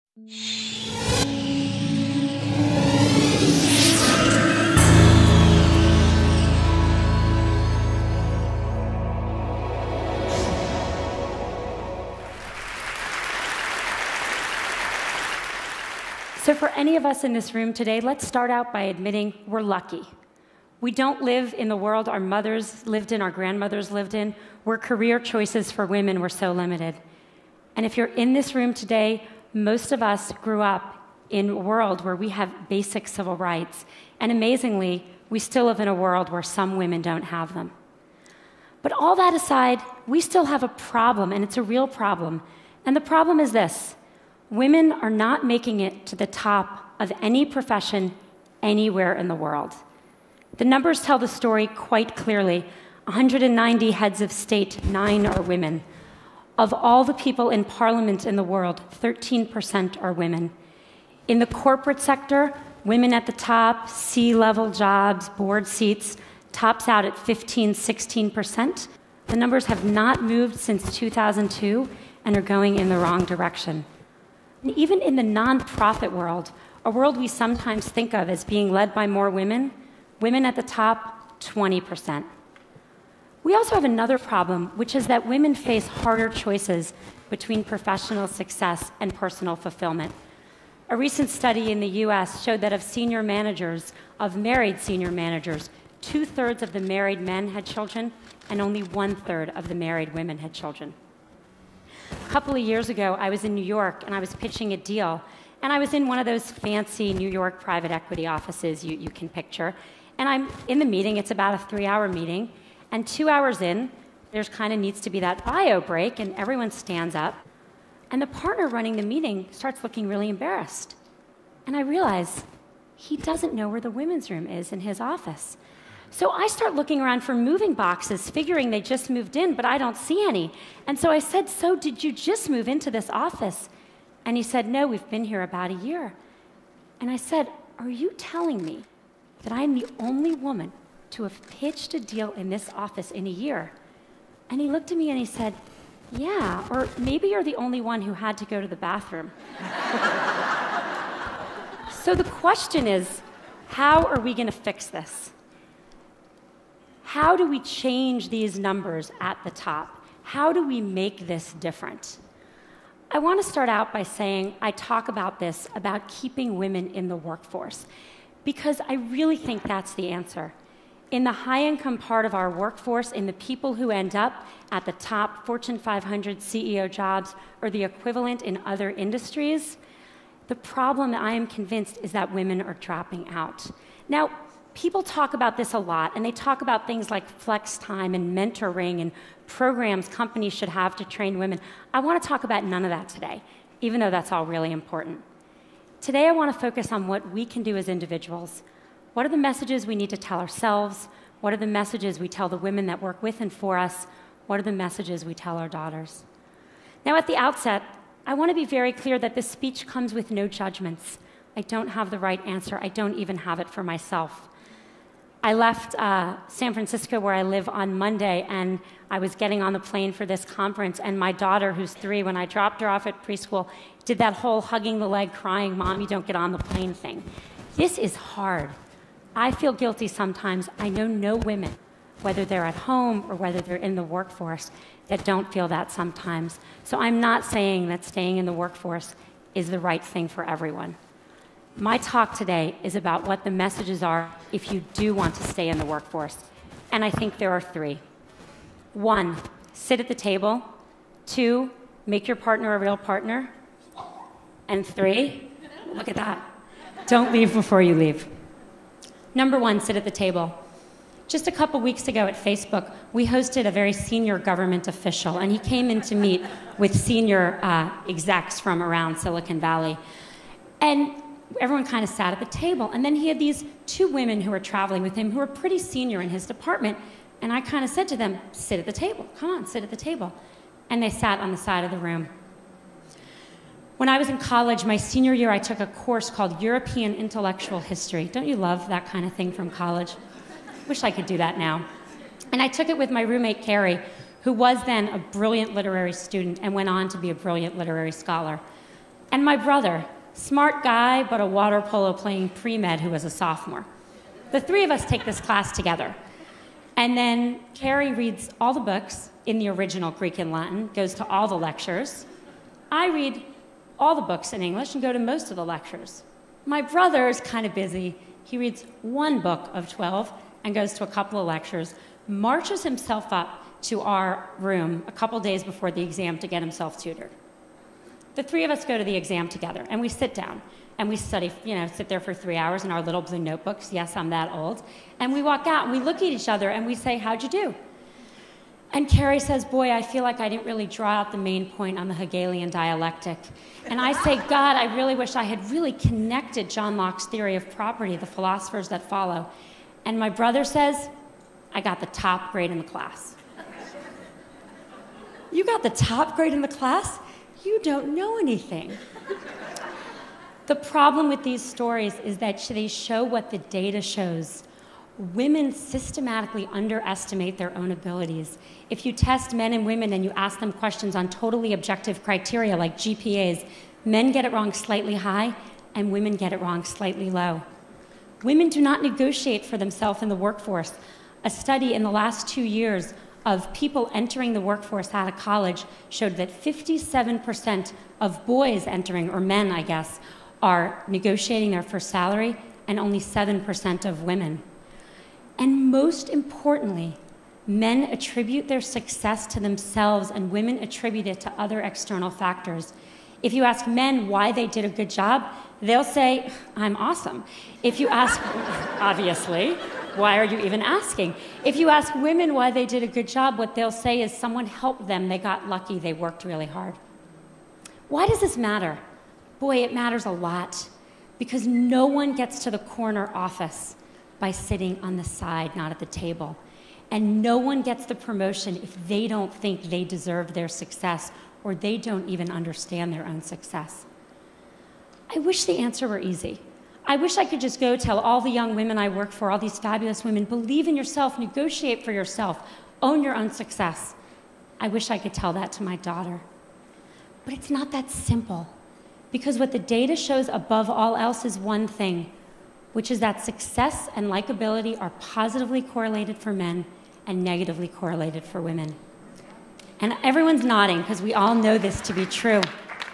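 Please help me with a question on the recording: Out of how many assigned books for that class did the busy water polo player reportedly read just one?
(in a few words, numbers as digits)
12.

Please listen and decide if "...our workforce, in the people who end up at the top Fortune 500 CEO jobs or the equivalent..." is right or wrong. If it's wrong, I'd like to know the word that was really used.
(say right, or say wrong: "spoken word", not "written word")
right.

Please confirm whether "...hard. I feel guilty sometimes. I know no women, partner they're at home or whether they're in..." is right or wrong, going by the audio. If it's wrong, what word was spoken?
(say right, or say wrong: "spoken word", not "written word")
wrong: "whether", not "partner".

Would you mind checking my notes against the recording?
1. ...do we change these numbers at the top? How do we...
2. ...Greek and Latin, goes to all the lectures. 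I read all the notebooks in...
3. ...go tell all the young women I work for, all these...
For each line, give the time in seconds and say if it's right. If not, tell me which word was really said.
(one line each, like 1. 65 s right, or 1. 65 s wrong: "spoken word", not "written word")
1. 157 s right
2. 310 s wrong: "books", not "notebooks"
3. 437 s right.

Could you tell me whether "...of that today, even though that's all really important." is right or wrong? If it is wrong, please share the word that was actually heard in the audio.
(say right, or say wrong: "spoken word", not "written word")
right.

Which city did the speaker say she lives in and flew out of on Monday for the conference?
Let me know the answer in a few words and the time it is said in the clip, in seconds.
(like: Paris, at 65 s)
San Francisco, at 216 s.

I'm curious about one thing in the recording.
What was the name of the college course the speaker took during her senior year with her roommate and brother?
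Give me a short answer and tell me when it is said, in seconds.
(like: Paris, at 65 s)
European Intellectual History, at 286 s.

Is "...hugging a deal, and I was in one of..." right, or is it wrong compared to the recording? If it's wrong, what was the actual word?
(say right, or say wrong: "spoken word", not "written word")
wrong: "pitching", not "hugging".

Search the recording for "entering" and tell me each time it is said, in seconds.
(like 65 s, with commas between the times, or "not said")
384 s, 388 s.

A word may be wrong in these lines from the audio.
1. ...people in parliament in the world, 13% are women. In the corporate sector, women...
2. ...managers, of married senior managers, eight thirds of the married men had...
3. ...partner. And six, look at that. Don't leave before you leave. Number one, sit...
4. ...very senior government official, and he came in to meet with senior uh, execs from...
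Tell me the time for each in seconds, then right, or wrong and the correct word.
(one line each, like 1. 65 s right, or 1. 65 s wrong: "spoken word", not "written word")
1. 57 s right
2. 93 s wrong: "two", not "eight"
3. 252 s wrong: "three", not "six"
4. 263 s right.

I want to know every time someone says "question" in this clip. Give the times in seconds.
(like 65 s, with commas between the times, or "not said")
152 s, 370 s.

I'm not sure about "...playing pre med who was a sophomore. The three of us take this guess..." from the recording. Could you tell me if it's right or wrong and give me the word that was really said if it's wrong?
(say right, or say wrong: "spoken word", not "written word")
wrong: "class", not "guess".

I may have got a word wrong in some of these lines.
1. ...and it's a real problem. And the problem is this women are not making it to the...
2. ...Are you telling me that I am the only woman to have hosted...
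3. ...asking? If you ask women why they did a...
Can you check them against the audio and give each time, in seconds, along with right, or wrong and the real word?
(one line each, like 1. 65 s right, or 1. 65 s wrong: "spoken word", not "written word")
1. 41 s right
2. 137 s wrong: "pitched", not "hosted"
3. 410 s right.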